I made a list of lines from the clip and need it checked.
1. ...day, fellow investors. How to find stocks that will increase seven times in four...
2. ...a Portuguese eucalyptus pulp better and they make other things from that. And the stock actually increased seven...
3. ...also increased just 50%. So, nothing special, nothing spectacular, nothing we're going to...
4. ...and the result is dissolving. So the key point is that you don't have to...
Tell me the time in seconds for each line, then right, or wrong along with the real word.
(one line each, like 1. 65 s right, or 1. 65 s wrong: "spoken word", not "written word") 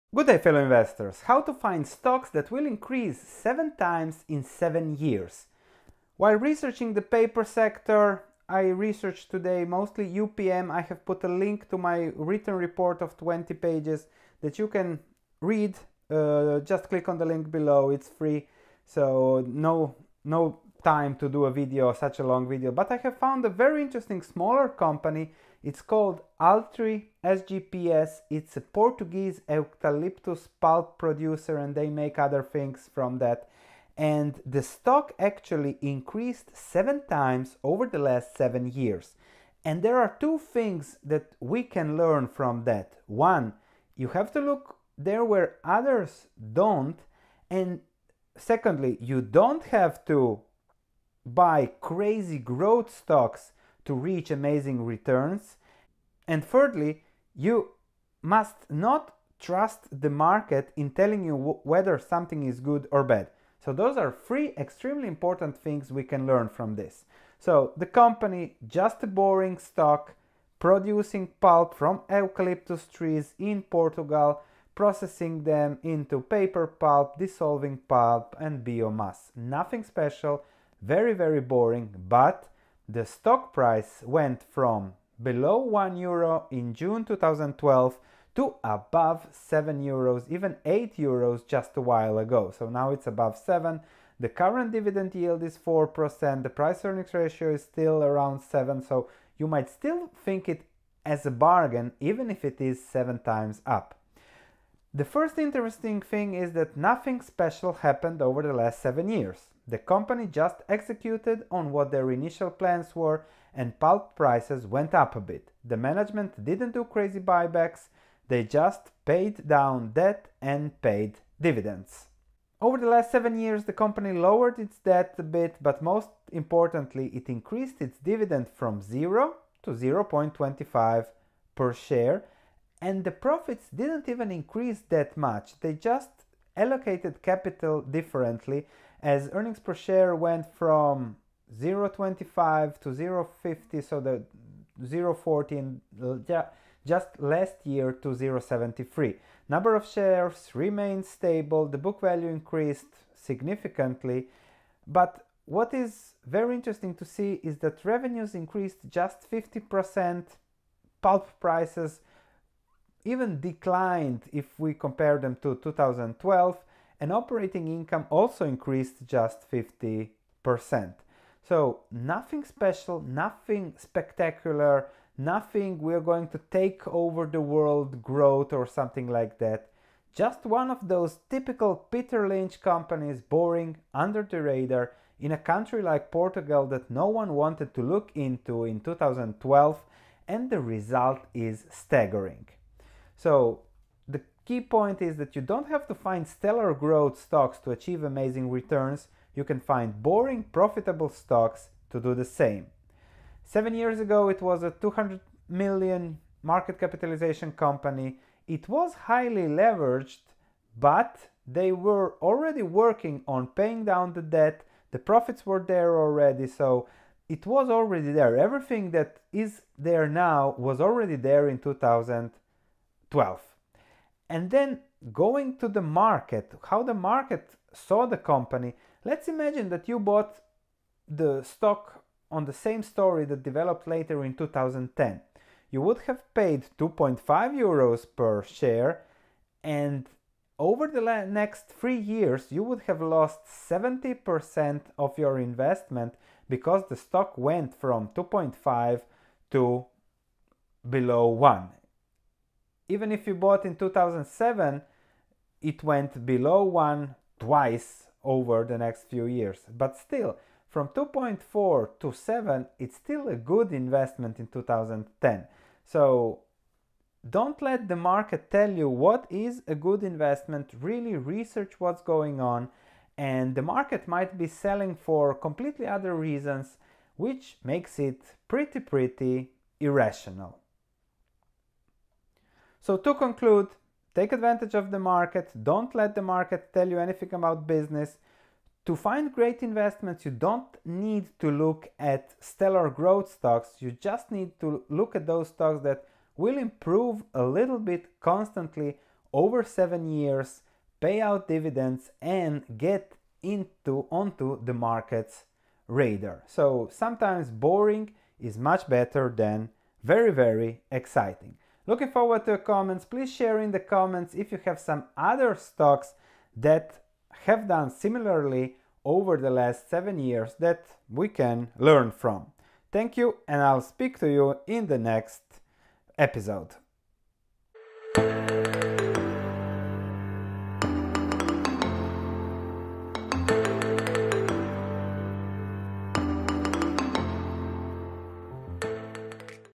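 1. 0 s wrong: "seven", not "four"
2. 28 s wrong: "producer", not "better"
3. 168 s right
4. 190 s wrong: "staggering", not "dissolving".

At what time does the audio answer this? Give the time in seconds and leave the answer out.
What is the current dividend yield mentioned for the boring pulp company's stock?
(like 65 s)
95 s.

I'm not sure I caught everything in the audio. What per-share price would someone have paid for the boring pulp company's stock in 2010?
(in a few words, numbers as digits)
2.5 euros.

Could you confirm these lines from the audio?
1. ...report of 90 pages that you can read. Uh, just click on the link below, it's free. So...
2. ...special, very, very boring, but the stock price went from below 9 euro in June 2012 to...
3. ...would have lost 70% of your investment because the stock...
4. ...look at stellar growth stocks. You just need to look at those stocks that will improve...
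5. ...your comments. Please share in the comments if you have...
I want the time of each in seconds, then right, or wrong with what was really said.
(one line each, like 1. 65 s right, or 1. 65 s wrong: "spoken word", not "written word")
1. 12 s wrong: "20", not "90"
2. 79 s wrong: "1", not "9"
3. 242 s right
4. 291 s right
5. 312 s right.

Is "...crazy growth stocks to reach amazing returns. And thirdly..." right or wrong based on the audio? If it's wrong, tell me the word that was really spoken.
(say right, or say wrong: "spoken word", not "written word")
right.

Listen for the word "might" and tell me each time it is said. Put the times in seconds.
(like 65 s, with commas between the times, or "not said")
99 s, 274 s.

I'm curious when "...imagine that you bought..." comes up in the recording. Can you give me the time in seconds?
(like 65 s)
229 s.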